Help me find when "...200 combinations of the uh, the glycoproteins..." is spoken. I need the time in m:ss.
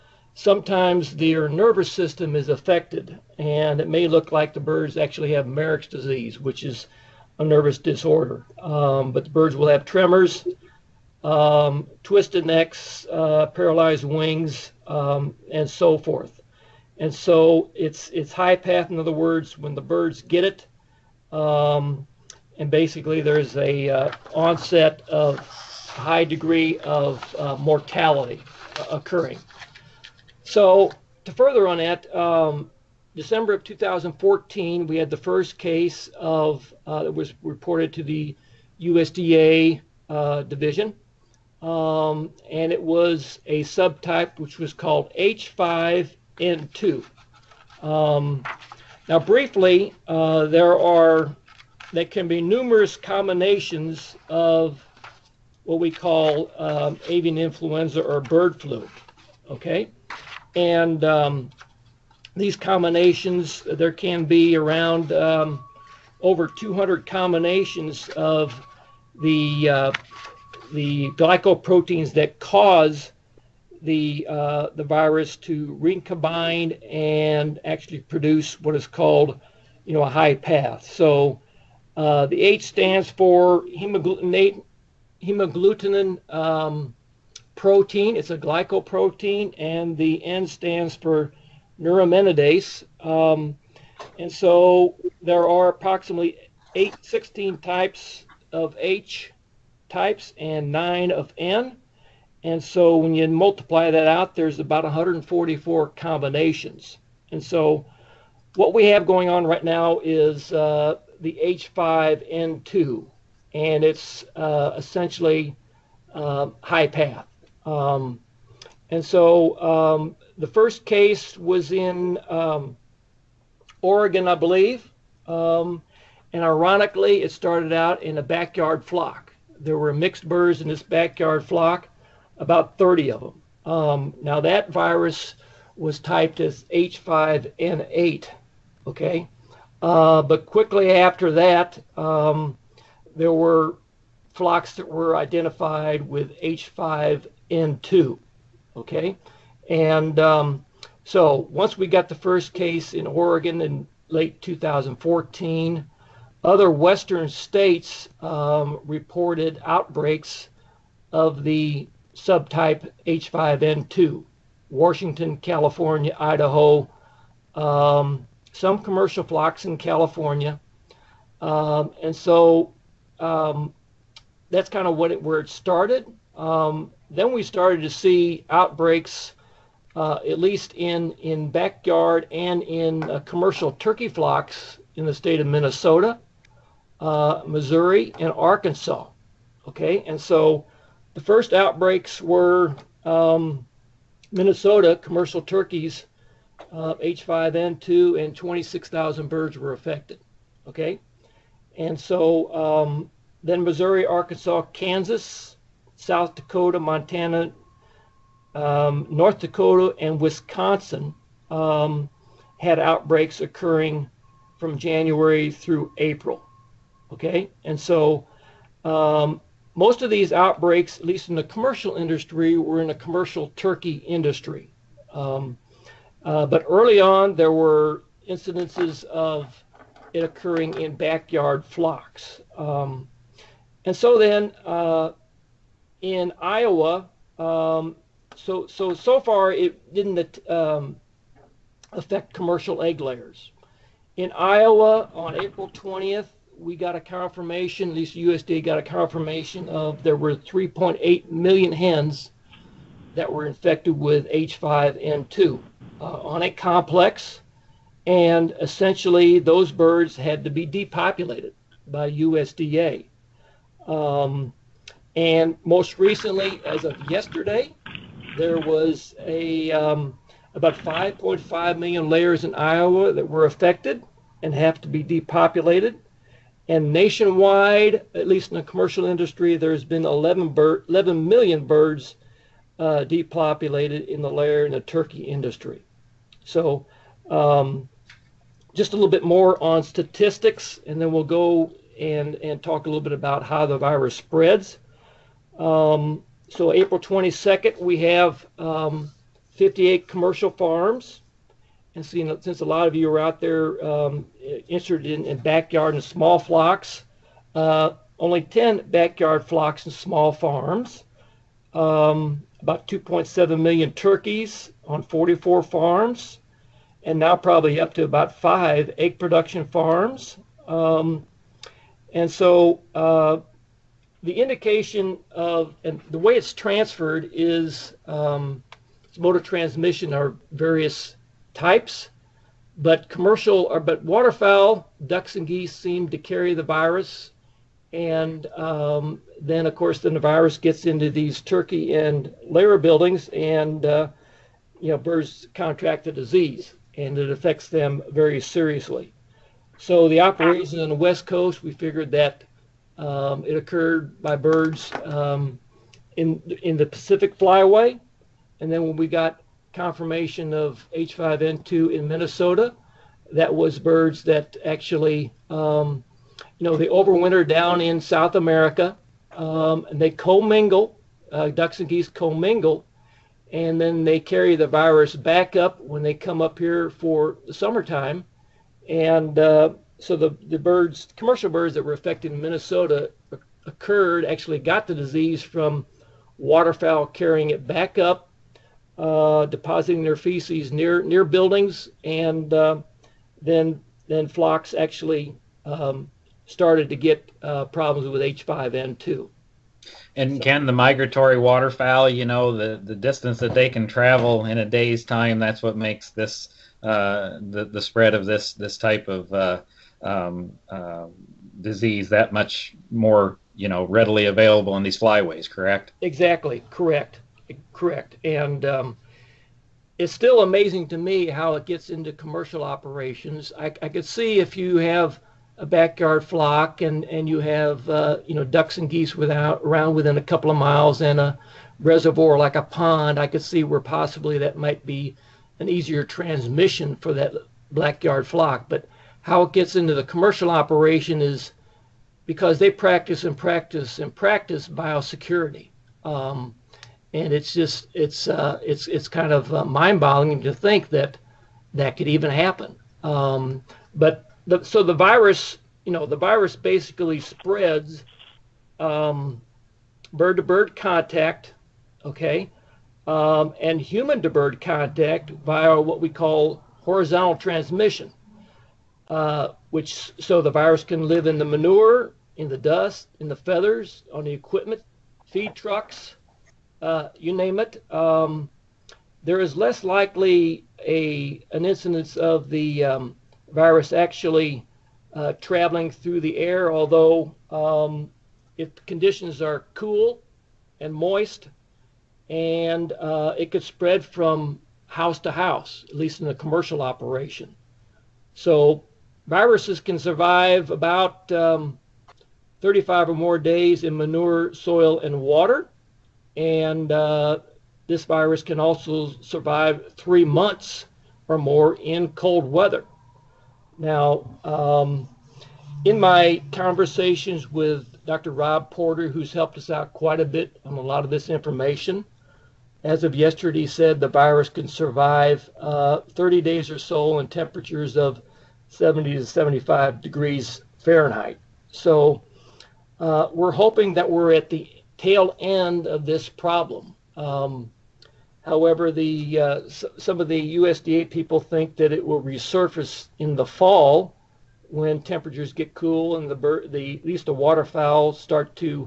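1:06.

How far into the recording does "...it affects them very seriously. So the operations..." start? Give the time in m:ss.
5:47.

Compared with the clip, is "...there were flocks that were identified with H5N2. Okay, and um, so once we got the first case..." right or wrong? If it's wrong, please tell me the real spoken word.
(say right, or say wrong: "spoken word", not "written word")
right.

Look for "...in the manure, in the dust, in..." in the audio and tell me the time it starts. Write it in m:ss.
7:51.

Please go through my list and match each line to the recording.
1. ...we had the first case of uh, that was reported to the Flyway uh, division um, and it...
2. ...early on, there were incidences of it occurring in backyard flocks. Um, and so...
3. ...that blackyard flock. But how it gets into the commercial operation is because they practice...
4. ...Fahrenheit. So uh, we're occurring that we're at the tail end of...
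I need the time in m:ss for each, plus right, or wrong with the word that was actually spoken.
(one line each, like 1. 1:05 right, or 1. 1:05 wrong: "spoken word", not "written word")
1. 0:34 wrong: "USDA", not "Flyway"
2. 3:46 right
3. 7:17 right
4. 8:50 wrong: "hoping", not "occurring".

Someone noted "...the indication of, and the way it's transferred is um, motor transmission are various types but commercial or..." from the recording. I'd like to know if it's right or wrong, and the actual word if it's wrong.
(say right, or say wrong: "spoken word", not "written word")
right.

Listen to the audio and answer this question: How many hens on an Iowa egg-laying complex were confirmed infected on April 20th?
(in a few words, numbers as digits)
3.8 million.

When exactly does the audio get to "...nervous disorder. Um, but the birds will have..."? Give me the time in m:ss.
0:07.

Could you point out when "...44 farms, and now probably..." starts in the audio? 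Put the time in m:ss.
5:15.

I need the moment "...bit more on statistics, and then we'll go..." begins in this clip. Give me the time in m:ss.
4:49.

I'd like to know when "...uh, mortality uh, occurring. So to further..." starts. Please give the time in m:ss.
0:27.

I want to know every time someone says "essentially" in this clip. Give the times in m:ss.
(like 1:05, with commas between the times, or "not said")
1:54, 4:18.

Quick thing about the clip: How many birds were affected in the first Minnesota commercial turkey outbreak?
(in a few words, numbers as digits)
26,000.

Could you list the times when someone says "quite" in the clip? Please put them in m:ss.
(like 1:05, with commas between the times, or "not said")
8:39.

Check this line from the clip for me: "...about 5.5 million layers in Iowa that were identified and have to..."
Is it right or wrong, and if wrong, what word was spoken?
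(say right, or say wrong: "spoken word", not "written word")
wrong: "affected", not "identified".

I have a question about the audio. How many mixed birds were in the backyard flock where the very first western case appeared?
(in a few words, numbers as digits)
30.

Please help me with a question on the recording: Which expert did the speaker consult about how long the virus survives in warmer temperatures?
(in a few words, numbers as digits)
Dr. Rob Porter.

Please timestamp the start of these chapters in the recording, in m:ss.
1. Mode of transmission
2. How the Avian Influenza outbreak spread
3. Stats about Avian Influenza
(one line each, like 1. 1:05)
1. 5:23
2. 0:30
3. 4:24.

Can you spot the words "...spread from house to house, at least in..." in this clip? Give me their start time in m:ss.
8:13.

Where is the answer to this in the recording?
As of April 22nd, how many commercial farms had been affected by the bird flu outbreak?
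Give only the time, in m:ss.
4:59.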